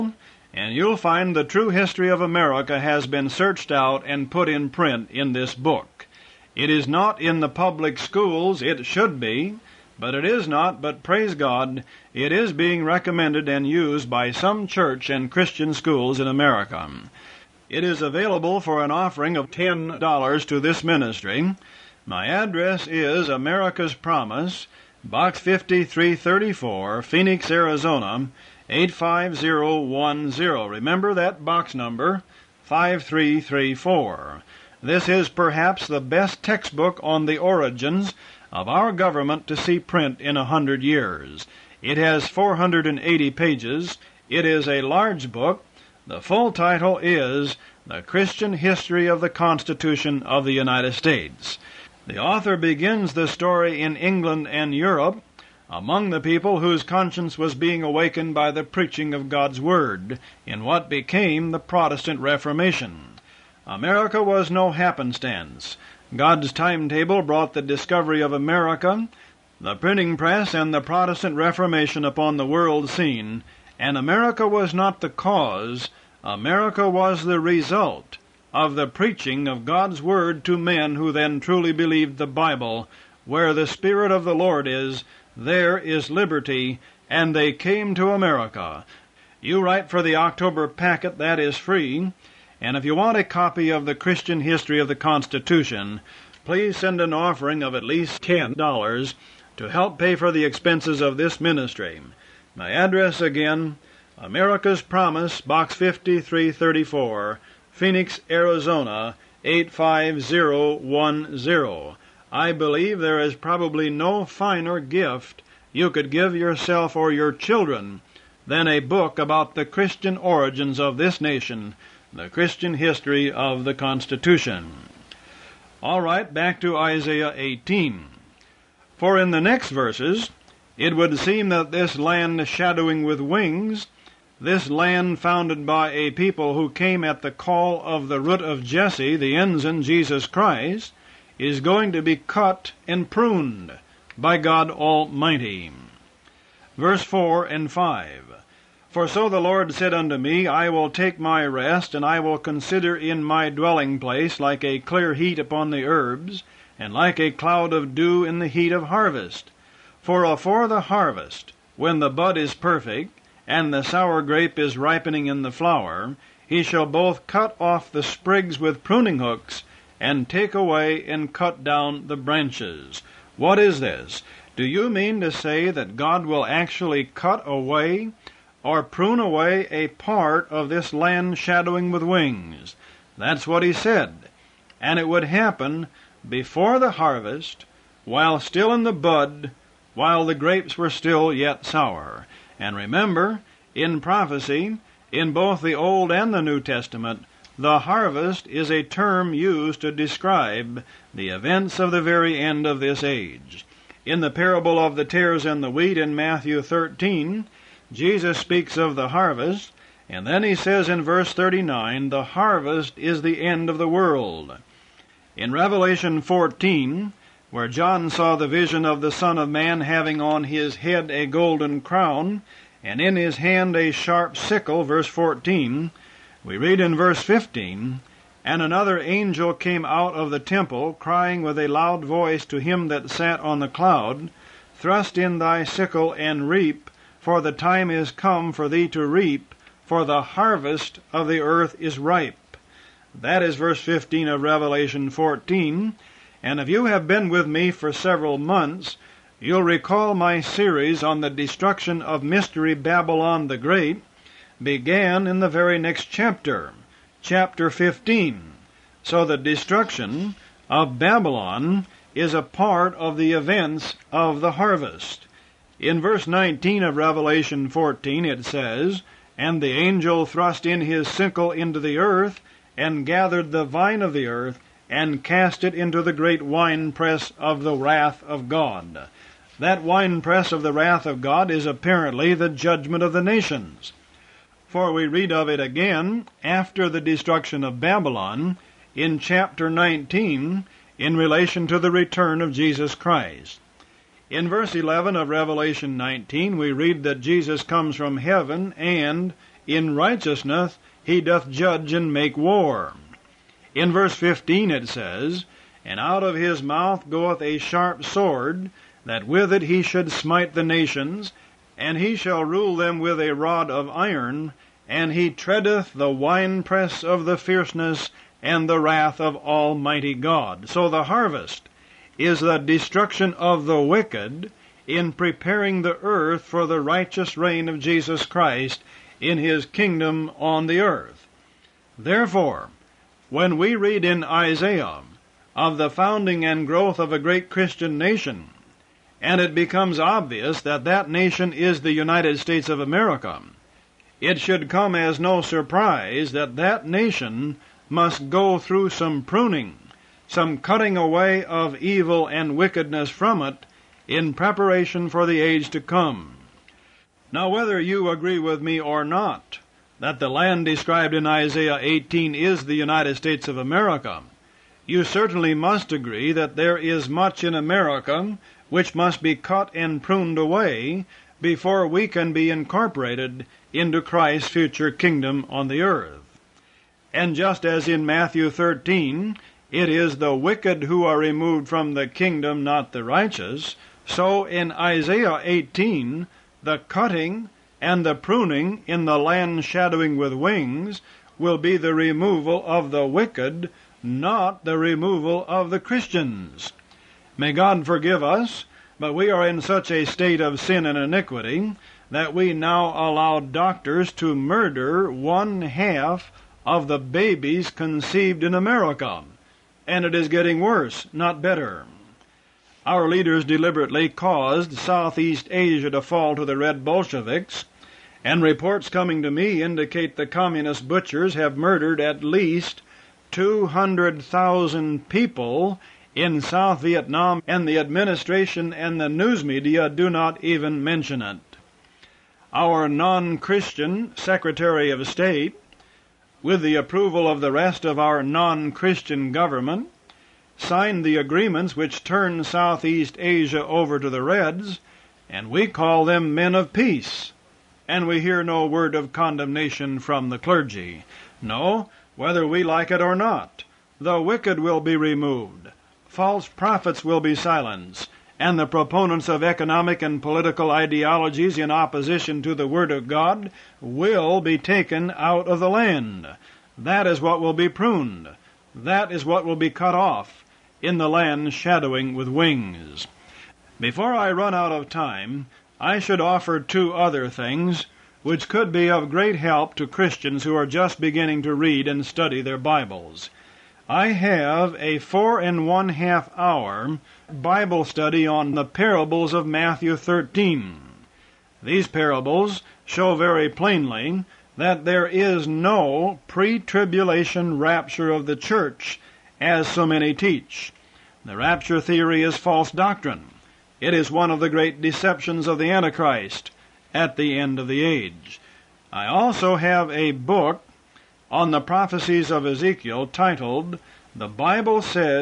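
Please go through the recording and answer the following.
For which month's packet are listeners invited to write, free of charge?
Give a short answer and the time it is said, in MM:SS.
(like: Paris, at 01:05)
October, at 01:30.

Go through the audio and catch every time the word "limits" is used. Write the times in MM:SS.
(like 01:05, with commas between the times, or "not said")
not said.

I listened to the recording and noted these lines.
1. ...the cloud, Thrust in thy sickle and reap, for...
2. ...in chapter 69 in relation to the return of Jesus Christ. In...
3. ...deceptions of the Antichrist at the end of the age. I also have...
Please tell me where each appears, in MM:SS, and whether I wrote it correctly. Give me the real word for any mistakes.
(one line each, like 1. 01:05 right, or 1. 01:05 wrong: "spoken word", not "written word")
1. 03:53 right
2. 04:48 wrong: "19", not "69"
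3. 08:24 right.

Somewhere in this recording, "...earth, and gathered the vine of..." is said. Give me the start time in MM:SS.
04:31.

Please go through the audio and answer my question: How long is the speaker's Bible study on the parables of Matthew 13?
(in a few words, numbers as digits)
4.5 hours.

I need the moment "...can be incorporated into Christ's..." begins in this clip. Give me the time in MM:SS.
06:12.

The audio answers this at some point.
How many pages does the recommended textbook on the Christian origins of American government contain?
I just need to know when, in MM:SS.
00:42.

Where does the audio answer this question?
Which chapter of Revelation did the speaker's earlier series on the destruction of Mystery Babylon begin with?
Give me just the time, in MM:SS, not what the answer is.
04:17.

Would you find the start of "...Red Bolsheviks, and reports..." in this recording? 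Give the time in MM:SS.
06:56.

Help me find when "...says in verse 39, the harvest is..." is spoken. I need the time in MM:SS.
03:30.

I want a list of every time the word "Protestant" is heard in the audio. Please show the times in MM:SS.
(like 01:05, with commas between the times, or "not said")
01:01, 01:10.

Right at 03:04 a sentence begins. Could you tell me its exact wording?
And it would happen before the harvest, while still in the bud, while the grapes were still yet sour.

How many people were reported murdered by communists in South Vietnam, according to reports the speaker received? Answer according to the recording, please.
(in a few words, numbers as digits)
200,000.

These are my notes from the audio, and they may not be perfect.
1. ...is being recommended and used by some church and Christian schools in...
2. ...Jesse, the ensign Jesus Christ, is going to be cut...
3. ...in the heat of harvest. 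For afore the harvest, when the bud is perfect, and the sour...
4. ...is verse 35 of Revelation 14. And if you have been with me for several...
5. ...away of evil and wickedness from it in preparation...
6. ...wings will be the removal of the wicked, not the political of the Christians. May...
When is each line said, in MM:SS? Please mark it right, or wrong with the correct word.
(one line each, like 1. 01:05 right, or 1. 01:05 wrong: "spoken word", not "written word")
1. 00:12 right
2. 02:18 right
3. 02:38 right
4. 04:03 wrong: "15", not "35"
5. 05:50 right
6. 06:30 wrong: "removal", not "political".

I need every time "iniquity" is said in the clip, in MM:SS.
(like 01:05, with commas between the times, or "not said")
06:40.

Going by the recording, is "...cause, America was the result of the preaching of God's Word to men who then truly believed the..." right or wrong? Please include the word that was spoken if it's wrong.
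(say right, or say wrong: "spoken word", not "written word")
right.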